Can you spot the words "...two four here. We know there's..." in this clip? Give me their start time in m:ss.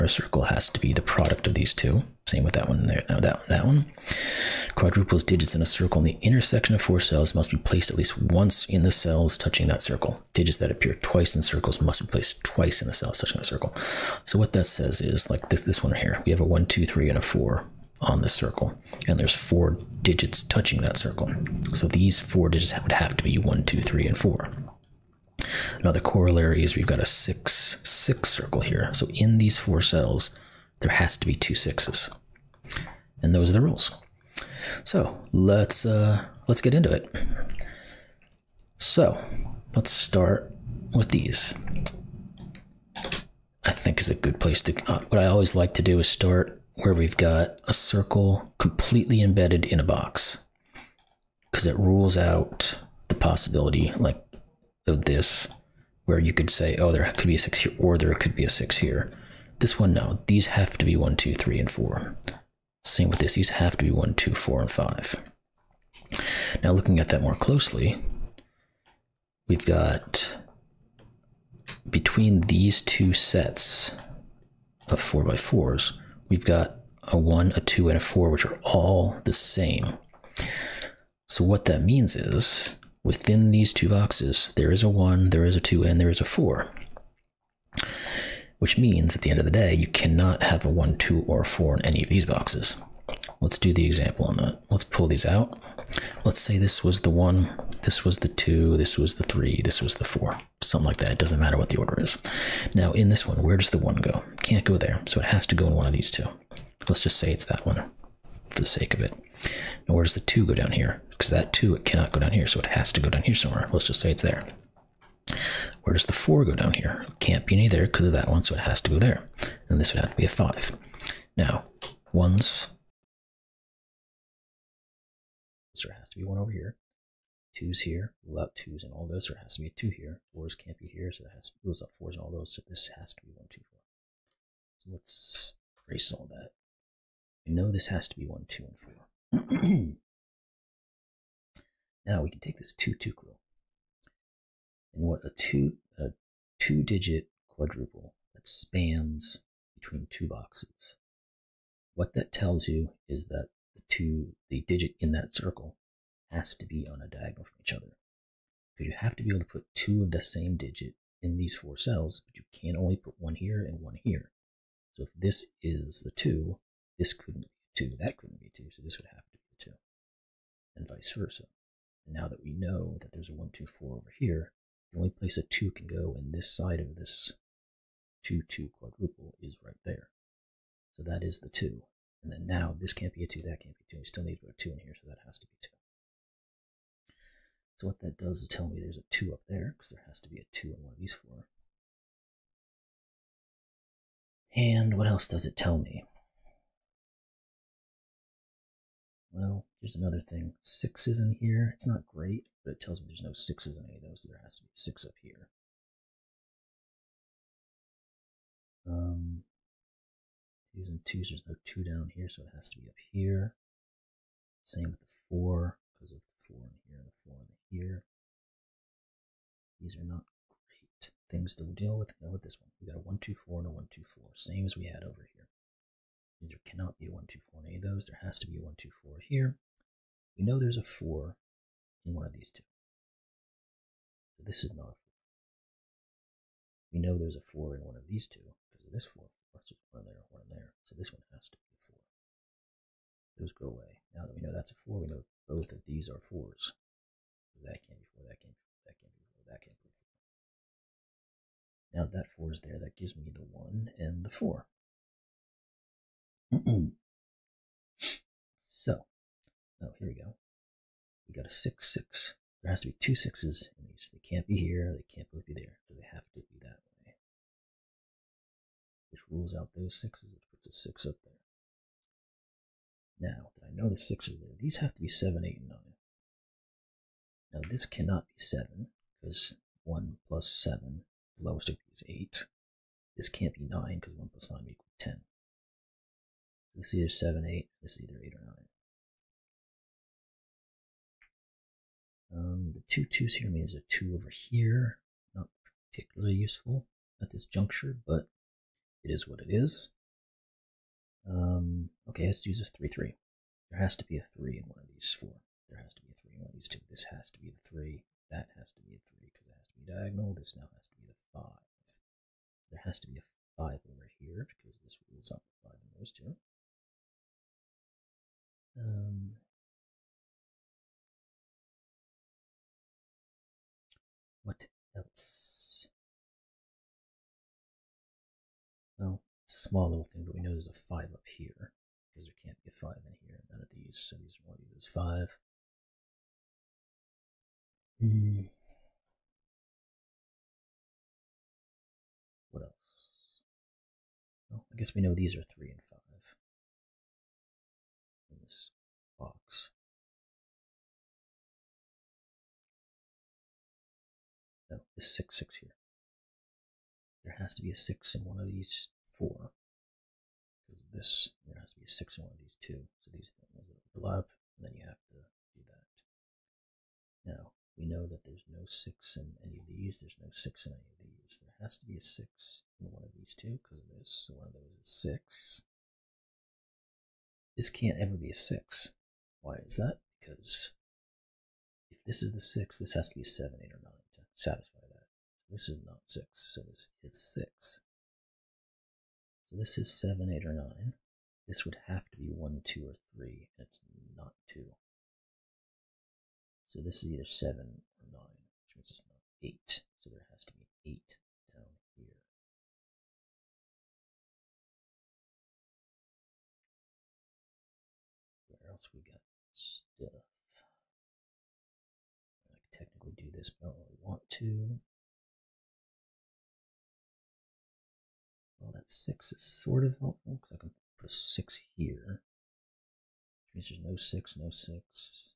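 3:48.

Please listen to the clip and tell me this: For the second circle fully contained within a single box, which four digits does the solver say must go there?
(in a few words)
1, 2, 4, and 5.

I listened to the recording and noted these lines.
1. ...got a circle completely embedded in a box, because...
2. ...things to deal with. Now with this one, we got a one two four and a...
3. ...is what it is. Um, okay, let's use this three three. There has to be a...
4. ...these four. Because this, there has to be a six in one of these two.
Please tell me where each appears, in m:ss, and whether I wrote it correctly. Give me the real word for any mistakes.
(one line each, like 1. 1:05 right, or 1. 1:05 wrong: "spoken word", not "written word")
1. 0:47 right
2. 3:41 right
3. 4:59 right
4. 5:58 right.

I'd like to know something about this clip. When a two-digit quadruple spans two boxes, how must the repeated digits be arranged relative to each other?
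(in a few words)
on a diagonal.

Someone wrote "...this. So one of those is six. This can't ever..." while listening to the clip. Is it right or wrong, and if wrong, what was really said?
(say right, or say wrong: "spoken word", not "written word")
right.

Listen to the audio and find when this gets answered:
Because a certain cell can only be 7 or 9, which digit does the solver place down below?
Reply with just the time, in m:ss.
6:40.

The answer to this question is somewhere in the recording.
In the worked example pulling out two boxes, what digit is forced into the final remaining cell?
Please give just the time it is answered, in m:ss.
1:59.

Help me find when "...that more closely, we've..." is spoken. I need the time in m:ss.
1:07.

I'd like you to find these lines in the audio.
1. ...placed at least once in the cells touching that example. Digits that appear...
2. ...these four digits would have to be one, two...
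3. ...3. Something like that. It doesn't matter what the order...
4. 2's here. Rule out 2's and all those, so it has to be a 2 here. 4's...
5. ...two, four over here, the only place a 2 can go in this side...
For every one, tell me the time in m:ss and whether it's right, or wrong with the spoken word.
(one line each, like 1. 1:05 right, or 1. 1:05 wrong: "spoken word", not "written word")
1. 0:07 wrong: "circle", not "example"
2. 0:21 right
3. 1:40 wrong: "4", not "3"
4. 2:07 right
5. 2:53 right.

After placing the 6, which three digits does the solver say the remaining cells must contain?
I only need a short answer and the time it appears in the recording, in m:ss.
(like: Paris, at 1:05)
7, 8, and 9, at 4:35.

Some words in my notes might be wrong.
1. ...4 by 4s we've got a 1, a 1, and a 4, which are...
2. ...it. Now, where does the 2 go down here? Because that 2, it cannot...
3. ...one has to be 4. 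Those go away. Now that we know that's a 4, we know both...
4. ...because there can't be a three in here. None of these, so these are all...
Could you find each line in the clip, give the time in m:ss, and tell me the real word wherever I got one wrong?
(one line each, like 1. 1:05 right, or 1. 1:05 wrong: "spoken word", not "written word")
1. 1:14 wrong: "2", not "1"
2. 1:49 right
3. 4:01 right
4. 5:32 wrong: "five", not "three".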